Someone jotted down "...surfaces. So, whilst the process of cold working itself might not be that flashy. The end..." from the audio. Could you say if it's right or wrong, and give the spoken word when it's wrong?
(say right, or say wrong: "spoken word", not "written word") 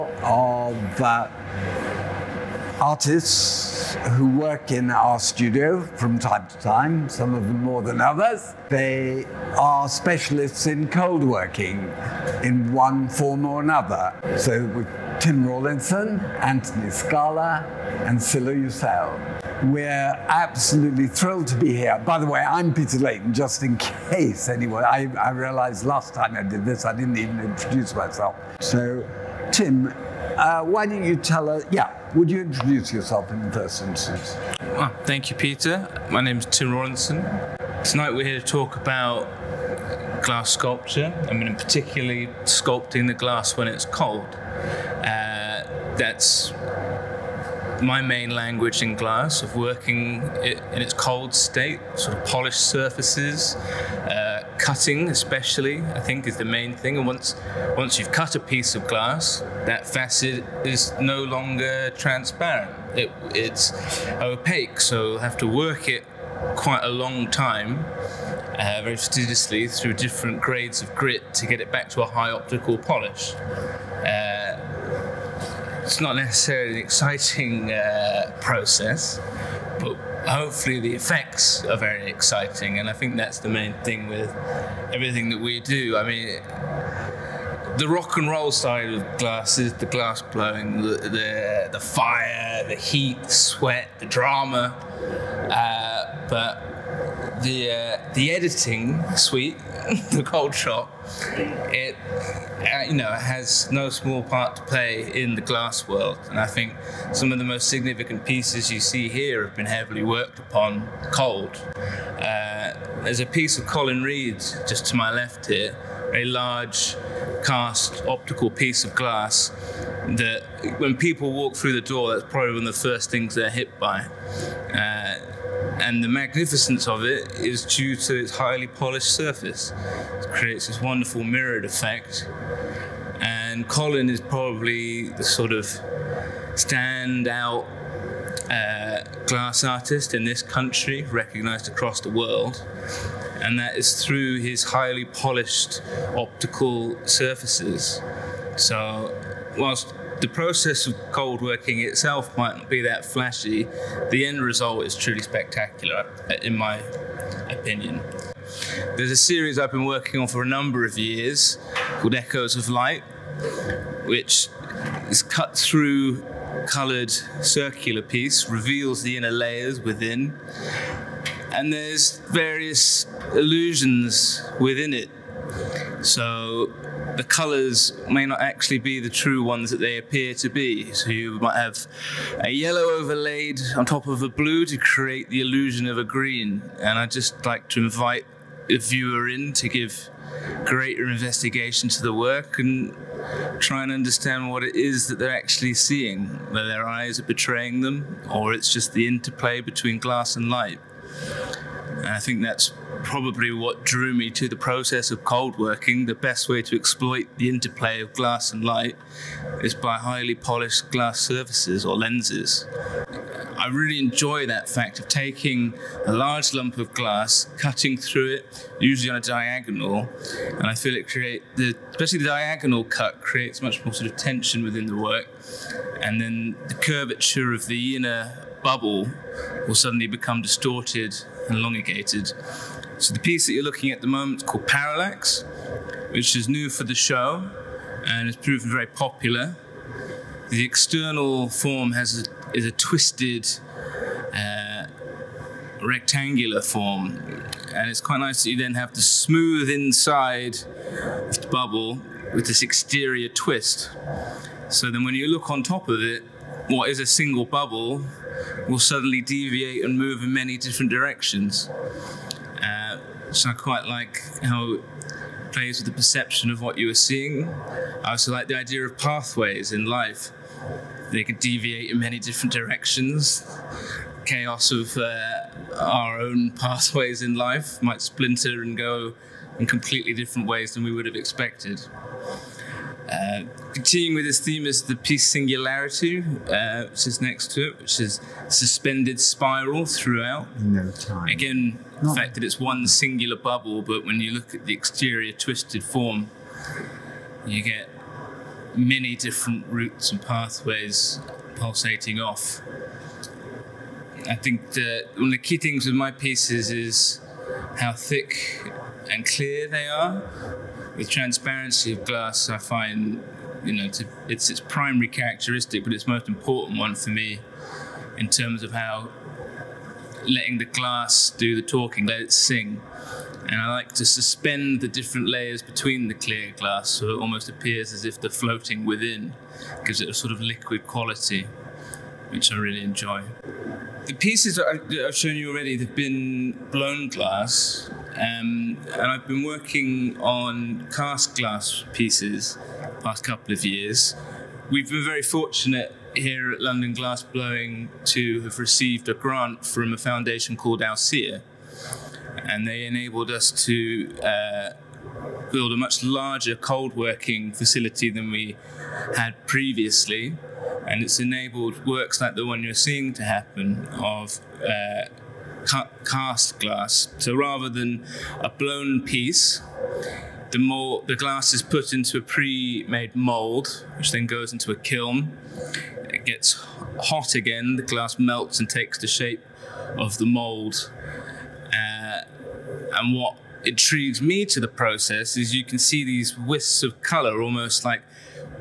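right.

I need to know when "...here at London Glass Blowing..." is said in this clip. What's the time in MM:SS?
05:46.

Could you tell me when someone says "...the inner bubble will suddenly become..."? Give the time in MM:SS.
03:47.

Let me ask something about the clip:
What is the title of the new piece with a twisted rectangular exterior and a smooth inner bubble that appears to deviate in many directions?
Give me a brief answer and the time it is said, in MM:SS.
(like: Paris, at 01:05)
Parallax, at 03:54.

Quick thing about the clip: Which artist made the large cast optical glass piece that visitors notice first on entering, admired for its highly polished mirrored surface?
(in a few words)
Colin Reid.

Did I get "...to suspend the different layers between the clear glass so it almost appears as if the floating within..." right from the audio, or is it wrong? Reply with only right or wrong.
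right.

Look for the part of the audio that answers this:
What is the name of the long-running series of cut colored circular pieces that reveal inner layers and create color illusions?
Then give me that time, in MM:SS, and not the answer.
02:42.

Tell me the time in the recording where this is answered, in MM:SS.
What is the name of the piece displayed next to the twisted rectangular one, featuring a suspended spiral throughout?
04:45.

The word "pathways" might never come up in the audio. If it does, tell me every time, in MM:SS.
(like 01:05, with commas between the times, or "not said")
04:28, 04:36, 05:00.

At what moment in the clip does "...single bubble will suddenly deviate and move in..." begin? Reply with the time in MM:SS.
04:17.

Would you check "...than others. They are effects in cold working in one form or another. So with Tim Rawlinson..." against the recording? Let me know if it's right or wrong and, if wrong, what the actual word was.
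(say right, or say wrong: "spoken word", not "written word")
wrong: "specialists", not "effects".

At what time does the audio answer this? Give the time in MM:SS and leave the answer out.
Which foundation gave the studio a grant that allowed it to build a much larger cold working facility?
05:50.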